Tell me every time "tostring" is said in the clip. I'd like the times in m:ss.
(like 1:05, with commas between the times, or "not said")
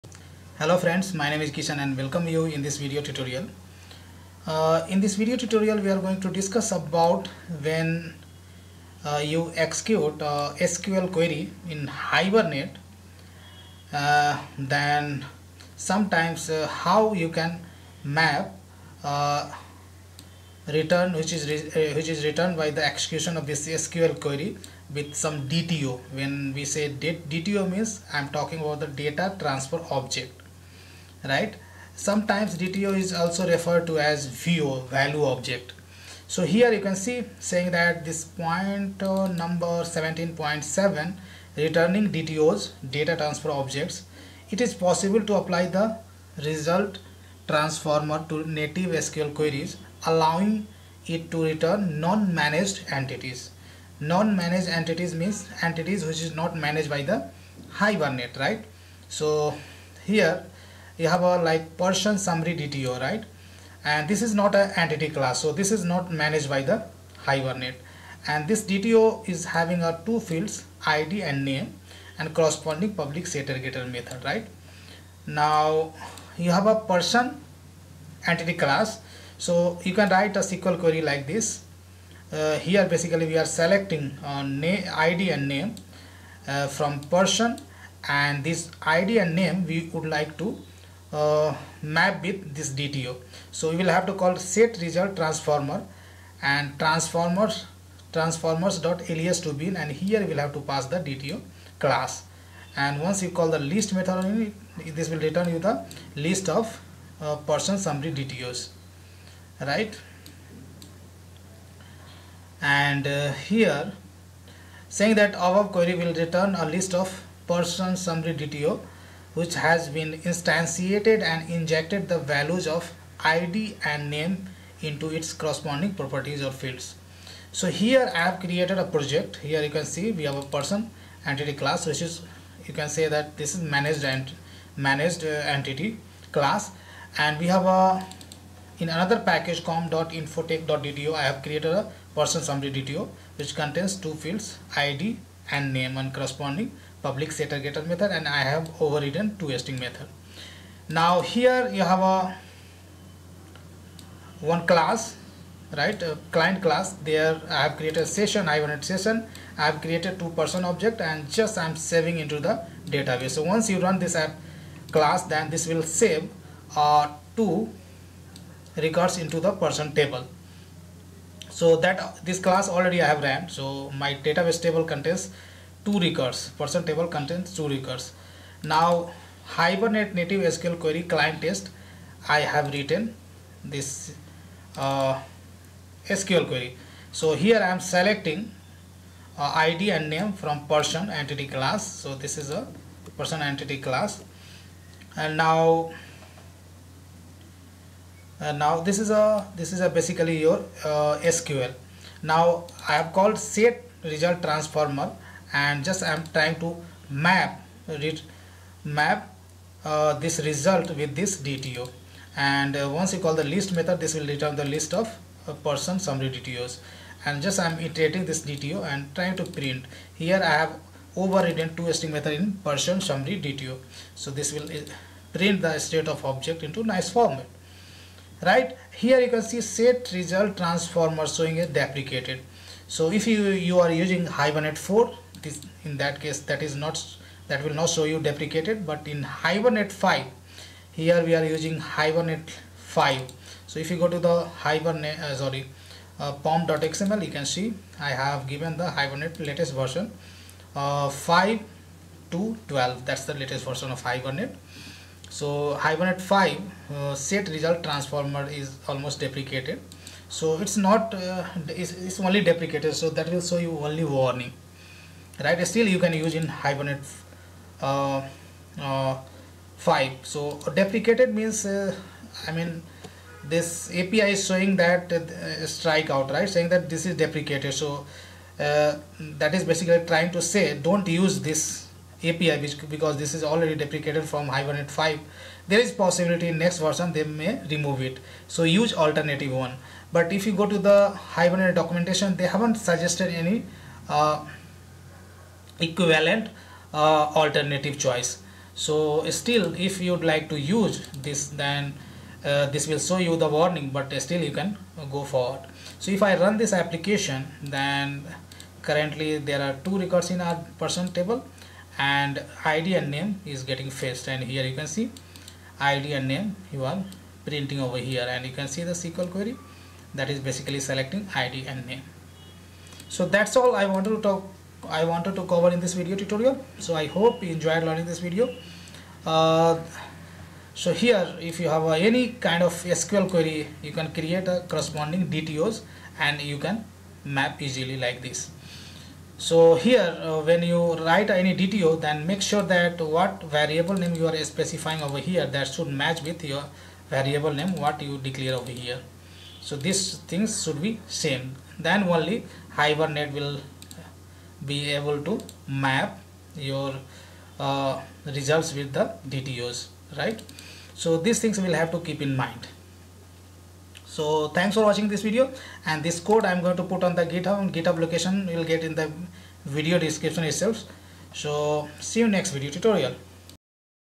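2:29, 3:41.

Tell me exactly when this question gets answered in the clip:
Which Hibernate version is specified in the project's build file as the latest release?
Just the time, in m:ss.
4:11.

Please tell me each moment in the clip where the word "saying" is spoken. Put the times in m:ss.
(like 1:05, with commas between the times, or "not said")
0:37, 1:54, 4:36.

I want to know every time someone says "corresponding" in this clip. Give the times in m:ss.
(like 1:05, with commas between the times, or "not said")
1:12, 2:05, 2:26, 5:34.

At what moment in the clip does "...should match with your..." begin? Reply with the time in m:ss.
5:45.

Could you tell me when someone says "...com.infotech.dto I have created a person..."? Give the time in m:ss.
2:19.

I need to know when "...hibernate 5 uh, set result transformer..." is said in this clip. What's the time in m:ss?
4:15.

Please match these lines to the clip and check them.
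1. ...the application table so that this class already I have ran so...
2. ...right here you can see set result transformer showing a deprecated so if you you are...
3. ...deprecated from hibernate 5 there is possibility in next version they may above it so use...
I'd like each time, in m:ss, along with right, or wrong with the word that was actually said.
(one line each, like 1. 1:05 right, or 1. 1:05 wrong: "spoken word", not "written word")
1. 2:49 wrong: "person", not "application"
2. 3:48 right
3. 4:43 wrong: "remove", not "above".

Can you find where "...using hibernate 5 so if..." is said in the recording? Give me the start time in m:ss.
4:01.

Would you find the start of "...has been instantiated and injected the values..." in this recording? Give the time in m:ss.
1:59.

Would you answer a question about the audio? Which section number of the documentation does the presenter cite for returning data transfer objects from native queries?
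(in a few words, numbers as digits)
17.7.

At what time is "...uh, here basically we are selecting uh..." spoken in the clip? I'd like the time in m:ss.
1:22.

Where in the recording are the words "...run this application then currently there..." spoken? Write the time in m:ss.
5:06.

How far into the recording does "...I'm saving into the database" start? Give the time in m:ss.
2:41.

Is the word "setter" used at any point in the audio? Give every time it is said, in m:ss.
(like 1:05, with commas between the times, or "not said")
1:13, 2:27.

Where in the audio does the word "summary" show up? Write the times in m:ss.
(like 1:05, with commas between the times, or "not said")
1:02, 1:47, 1:57, 2:22, 3:35, 3:43.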